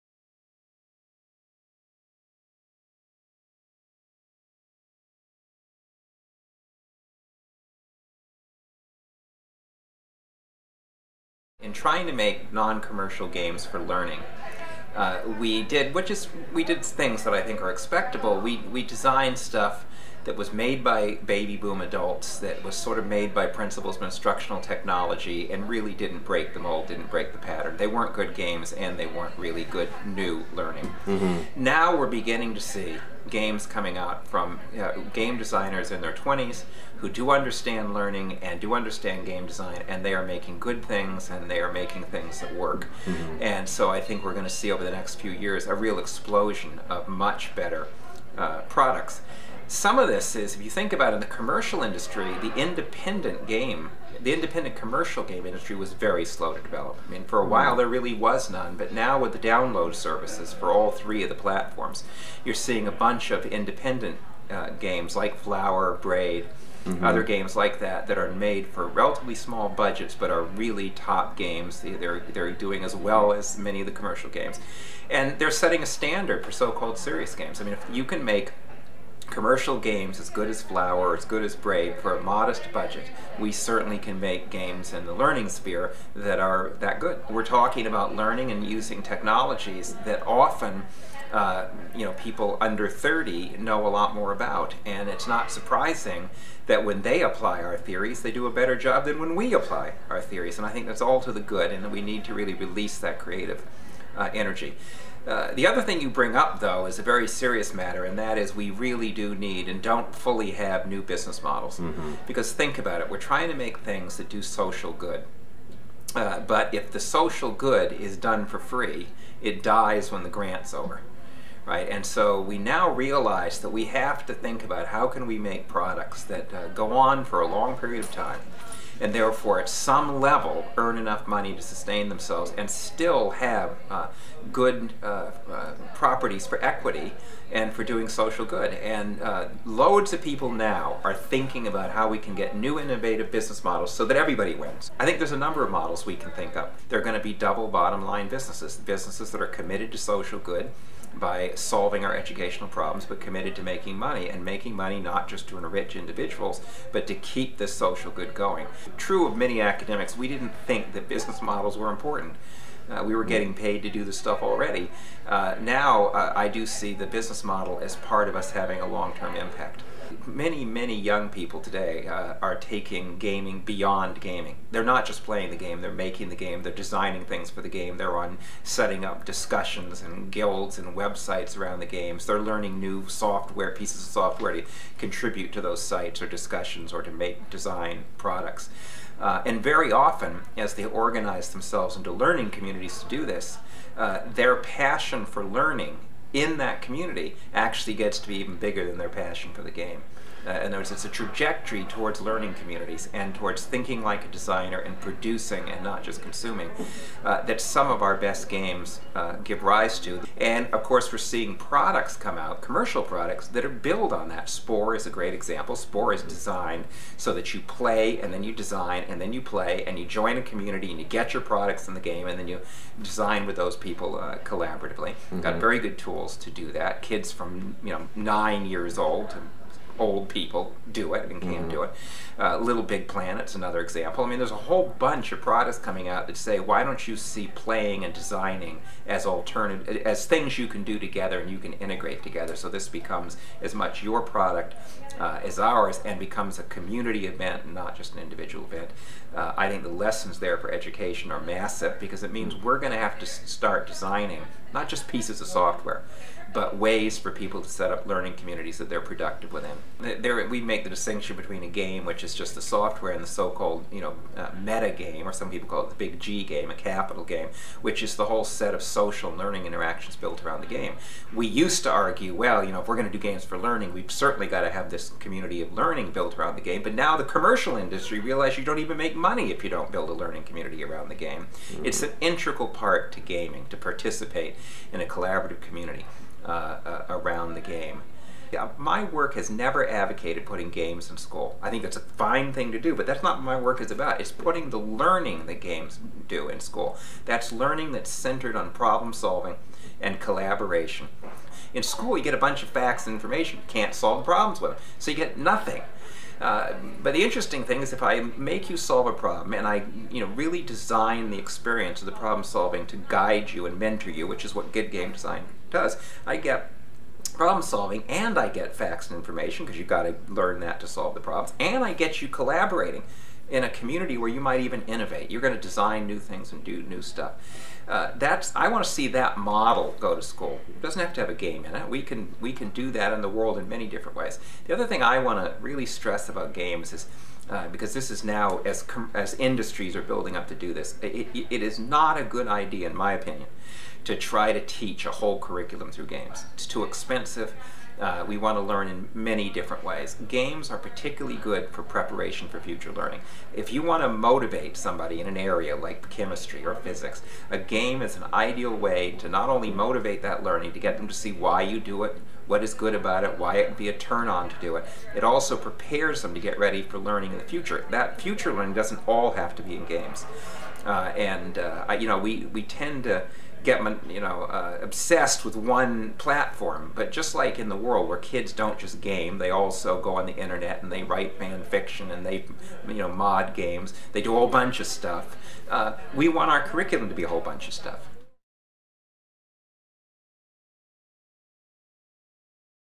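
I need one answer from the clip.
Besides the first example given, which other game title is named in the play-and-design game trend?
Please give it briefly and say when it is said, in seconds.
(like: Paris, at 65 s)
Little Big Planet, at 232 s.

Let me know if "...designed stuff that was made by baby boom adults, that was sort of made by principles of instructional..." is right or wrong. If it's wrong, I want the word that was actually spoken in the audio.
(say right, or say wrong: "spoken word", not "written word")
right.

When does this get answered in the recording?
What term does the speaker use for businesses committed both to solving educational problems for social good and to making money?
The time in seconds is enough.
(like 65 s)
147 s.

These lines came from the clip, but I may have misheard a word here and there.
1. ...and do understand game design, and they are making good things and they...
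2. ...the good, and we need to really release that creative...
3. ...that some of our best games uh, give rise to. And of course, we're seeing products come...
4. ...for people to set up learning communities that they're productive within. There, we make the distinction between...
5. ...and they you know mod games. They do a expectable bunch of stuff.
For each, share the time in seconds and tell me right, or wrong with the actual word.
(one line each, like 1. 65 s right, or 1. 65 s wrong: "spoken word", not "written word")
1. 38 s right
2. 101 s right
3. 207 s right
4. 257 s right
5. 382 s wrong: "whole", not "expectable".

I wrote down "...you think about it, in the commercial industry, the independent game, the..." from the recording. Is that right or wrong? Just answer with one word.
right.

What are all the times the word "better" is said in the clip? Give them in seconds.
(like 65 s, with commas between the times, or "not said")
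47 s, 98 s.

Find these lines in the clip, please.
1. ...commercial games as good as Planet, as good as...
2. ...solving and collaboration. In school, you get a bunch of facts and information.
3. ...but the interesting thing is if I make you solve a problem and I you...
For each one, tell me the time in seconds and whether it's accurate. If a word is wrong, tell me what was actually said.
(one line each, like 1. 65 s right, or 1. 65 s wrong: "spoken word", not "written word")
1. 79 s wrong: "Flower", not "Planet"
2. 299 s right
3. 307 s right.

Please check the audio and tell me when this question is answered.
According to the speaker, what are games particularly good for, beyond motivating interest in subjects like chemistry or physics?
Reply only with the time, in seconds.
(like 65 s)
351 s.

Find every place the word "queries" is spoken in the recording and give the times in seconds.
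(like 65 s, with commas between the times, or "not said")
not said.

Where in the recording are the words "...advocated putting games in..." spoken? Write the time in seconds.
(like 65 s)
289 s.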